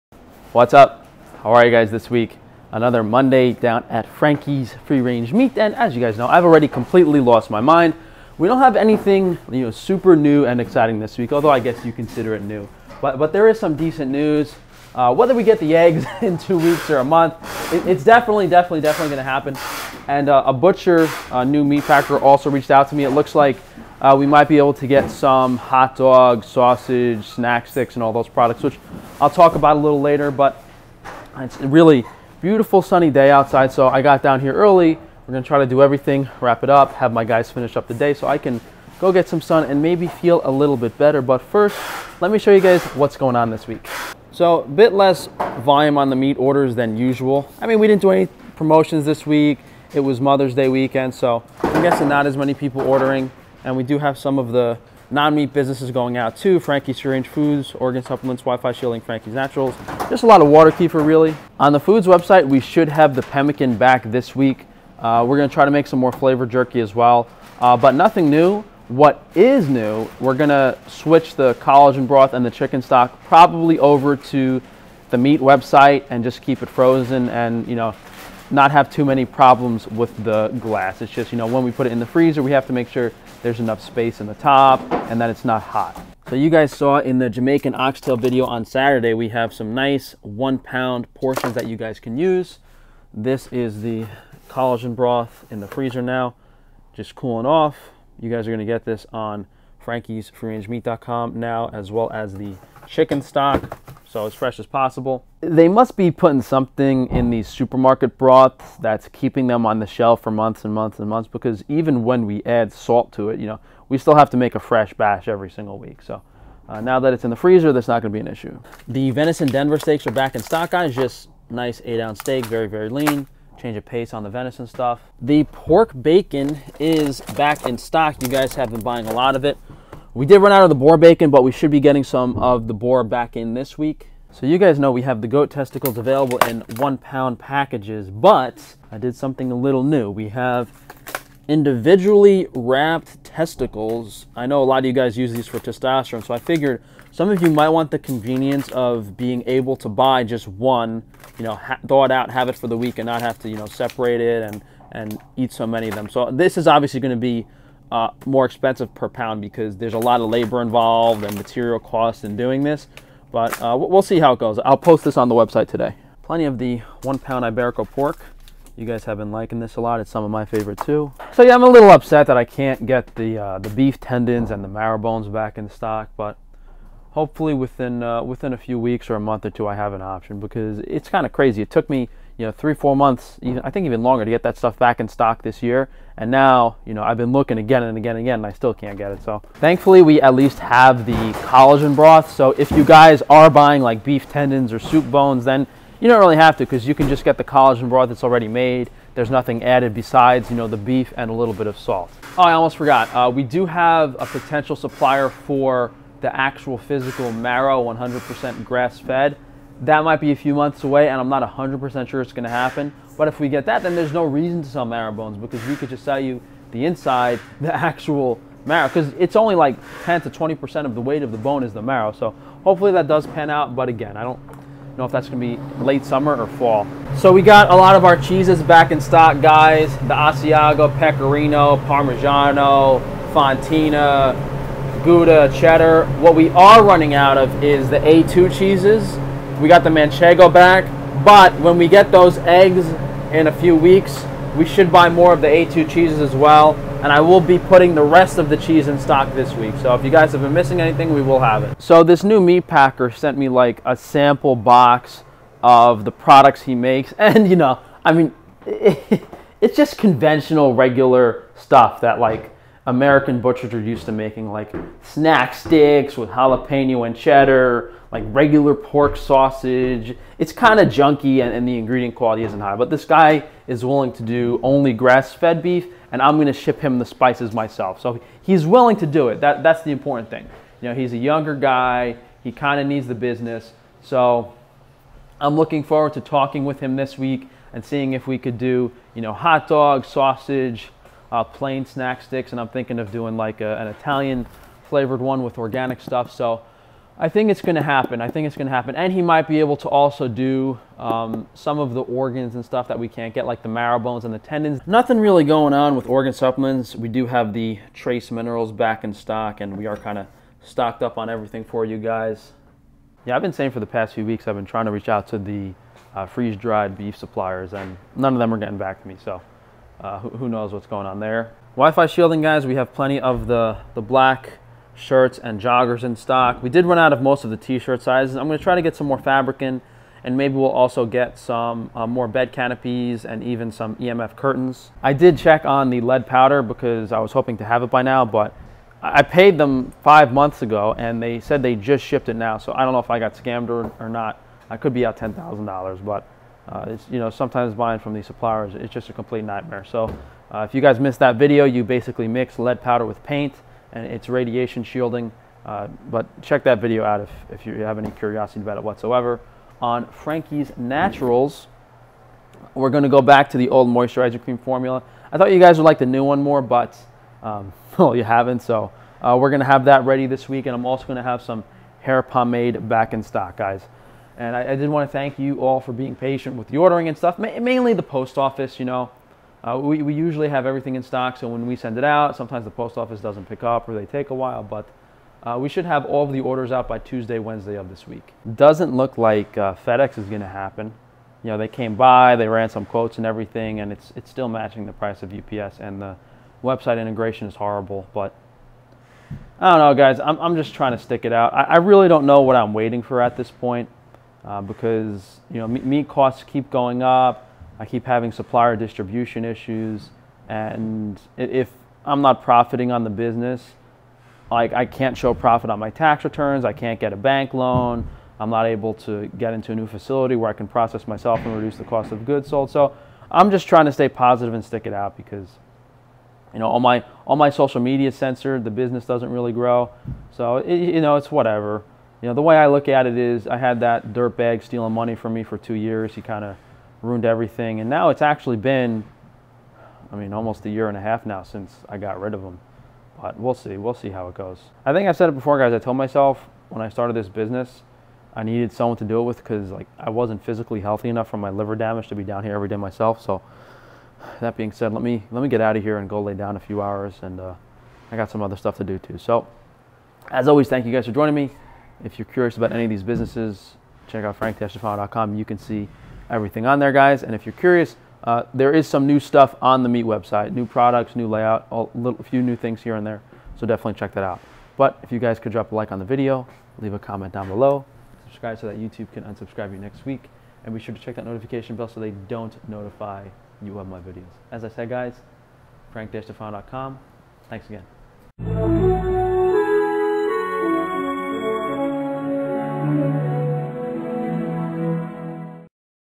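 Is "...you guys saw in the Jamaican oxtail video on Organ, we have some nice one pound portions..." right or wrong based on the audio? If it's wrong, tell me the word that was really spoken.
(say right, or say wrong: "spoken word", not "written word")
wrong: "Saturday", not "Organ".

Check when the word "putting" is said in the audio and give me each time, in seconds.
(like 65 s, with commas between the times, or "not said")
106 s, 247 s.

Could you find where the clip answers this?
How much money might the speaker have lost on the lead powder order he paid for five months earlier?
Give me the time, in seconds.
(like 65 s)
345 s.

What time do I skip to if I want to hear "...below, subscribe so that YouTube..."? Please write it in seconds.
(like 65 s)
477 s.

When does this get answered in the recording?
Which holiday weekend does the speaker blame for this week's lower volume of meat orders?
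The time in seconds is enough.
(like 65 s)
50 s.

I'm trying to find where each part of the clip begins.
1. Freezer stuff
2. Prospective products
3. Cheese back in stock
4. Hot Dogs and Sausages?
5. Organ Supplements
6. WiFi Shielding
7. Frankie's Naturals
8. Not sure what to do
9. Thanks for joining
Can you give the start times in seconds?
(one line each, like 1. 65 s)
1. 86 s
2. 202 s
3. 226 s
4. 251 s
5. 304 s
6. 321 s
7. 362 s
8. 388 s
9. 444 s.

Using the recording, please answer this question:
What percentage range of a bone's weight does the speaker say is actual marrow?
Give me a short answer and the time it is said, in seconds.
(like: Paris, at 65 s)
10 to 20%, at 220 s.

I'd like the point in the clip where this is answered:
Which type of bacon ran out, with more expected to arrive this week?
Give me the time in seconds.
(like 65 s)
130 s.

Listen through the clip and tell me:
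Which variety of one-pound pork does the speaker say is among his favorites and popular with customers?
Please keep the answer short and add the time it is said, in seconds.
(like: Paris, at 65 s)
Iberico, at 167 s.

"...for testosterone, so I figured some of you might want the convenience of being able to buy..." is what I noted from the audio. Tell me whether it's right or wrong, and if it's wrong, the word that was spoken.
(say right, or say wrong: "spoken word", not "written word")
right.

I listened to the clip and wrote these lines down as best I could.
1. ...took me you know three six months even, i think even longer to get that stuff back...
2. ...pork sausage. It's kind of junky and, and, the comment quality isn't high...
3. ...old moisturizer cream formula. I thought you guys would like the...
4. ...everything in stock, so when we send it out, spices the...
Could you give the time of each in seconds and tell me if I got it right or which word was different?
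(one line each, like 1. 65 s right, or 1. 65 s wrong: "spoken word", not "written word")
1. 181 s wrong: "four", not "six"
2. 268 s wrong: "ingredient", not "comment"
3. 363 s right
4. 380 s wrong: "sometimes", not "spices".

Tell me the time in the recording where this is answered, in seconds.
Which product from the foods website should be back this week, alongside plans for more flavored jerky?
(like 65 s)
63 s.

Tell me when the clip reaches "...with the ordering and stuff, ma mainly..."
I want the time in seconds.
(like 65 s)
376 s.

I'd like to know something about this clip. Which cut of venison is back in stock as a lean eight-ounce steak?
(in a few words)
Denver steaks.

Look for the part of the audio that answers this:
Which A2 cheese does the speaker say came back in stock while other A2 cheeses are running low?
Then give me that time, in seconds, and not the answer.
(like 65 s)
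239 s.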